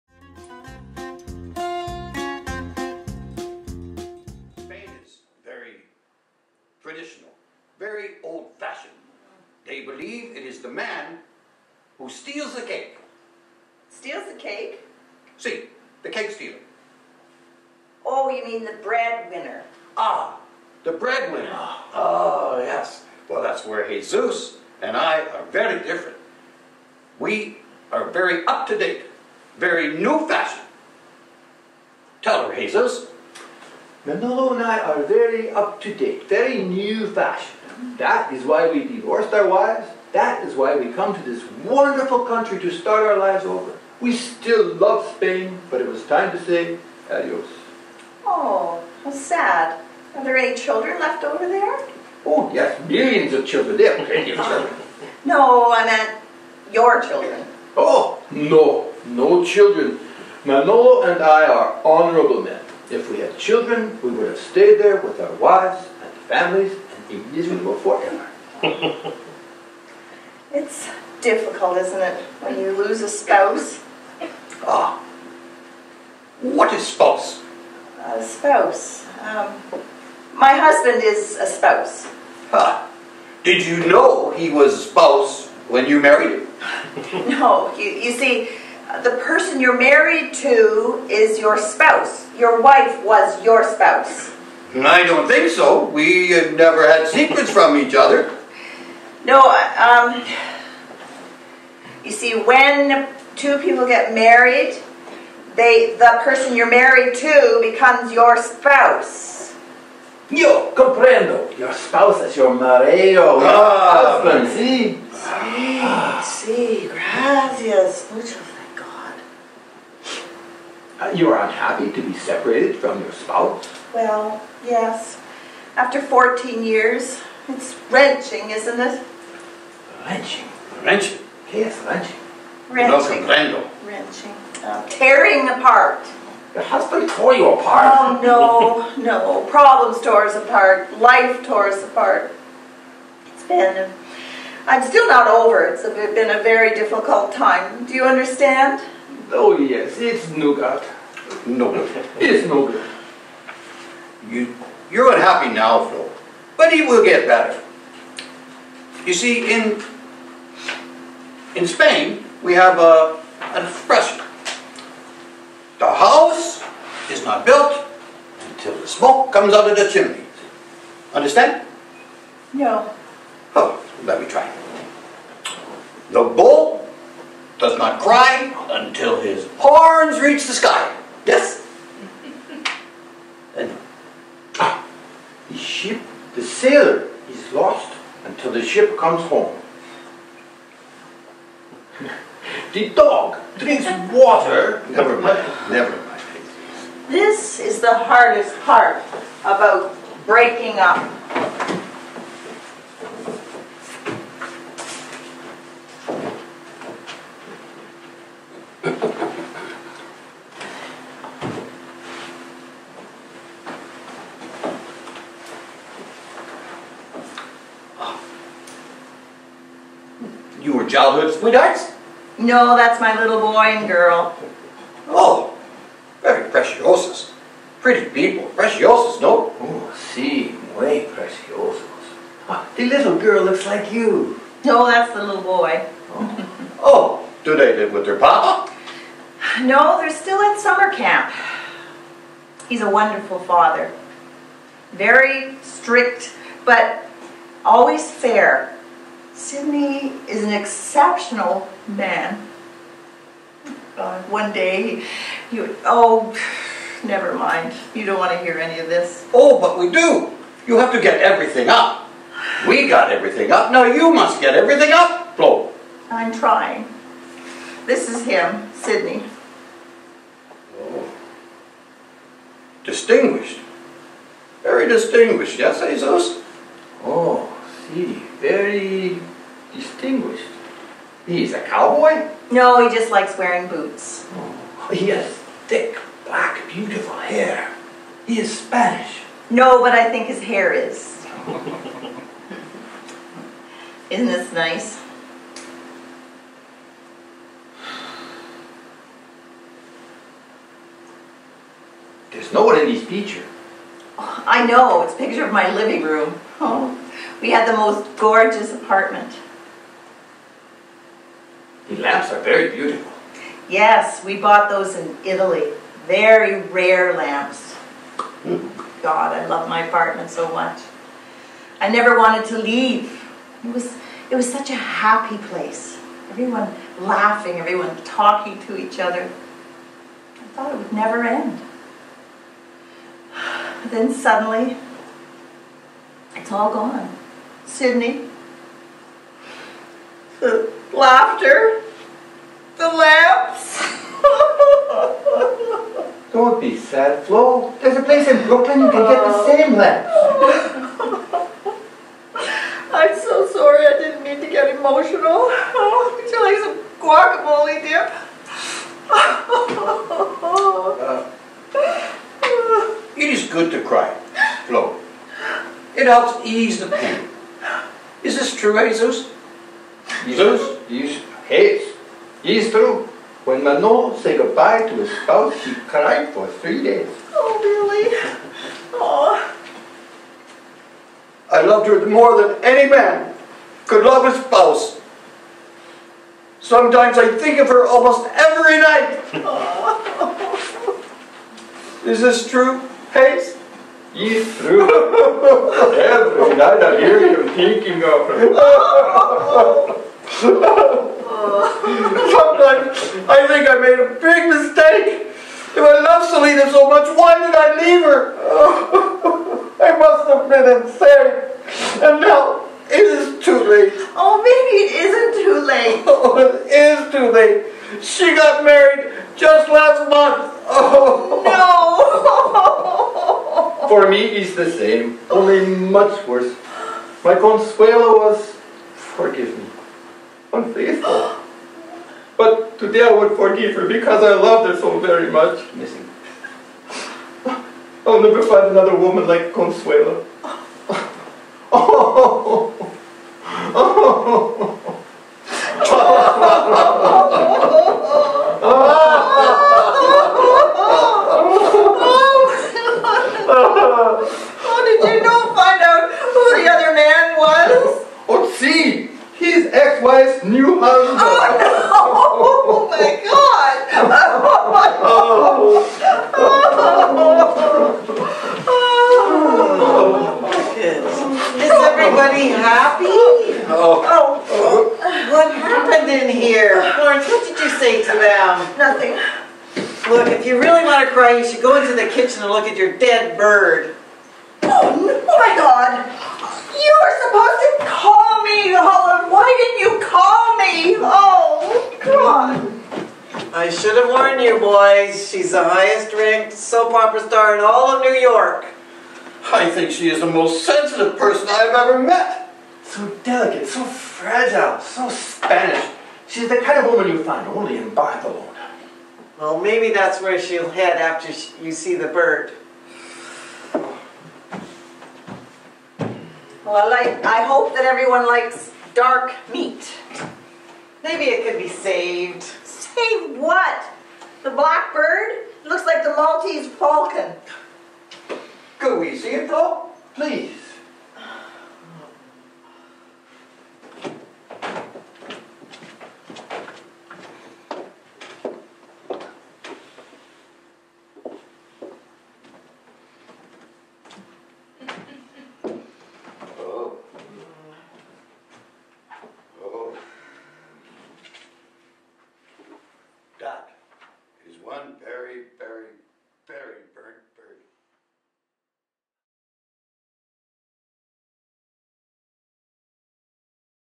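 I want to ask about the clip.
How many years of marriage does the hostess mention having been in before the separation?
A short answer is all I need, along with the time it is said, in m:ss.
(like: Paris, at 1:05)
14, at 2:05.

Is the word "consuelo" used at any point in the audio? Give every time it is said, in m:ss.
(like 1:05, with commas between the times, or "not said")
7:07, 7:19.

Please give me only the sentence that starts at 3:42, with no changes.
No, that's my little boy and girl.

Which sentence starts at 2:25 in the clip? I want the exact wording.
It's been a very difficult time.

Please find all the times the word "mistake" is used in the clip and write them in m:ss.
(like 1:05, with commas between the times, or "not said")
6:44.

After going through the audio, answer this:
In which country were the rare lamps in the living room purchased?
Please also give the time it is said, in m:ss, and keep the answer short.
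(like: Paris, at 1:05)
Italy, at 5:15.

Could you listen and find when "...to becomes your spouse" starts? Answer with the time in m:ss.
1:47.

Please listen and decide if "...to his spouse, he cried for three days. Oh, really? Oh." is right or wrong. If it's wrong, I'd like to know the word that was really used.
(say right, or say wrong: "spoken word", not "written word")
right.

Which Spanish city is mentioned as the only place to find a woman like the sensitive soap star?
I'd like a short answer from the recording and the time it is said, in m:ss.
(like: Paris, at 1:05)
Barcelona, at 8:27.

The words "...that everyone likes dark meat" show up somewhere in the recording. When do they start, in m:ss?
8:37.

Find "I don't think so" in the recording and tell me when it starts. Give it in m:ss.
1:34.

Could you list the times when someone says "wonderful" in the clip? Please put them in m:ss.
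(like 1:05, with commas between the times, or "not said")
0:41, 4:02.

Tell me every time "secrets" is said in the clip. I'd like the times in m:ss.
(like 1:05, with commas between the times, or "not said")
1:37.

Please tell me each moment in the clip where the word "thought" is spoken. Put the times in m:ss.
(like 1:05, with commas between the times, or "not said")
5:30.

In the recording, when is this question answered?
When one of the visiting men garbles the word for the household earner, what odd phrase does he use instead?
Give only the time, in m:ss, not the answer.
0:16.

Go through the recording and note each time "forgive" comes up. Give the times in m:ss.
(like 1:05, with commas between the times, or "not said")
7:08, 7:13.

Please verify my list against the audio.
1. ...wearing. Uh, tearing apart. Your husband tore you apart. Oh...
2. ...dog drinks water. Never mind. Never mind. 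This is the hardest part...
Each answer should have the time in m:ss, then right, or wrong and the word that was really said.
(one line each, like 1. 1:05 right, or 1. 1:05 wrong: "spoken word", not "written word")
1. 2:13 wrong: "wrenching", not "wearing"
2. 3:12 right.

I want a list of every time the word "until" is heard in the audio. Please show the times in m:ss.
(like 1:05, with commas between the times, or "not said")
2:48, 2:58.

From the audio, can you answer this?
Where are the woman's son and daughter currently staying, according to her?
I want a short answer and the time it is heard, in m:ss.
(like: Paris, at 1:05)
summer camp, at 4:00.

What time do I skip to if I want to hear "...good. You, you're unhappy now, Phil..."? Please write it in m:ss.
2:32.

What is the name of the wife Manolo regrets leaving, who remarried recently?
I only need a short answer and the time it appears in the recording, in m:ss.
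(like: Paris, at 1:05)
Selena, at 6:46.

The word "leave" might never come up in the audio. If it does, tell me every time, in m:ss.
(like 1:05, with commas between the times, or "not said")
5:22, 6:47.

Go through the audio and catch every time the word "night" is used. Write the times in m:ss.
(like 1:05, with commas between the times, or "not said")
6:28, 6:36.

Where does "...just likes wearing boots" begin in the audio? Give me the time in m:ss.
4:42.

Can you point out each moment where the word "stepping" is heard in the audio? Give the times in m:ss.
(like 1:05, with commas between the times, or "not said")
not said.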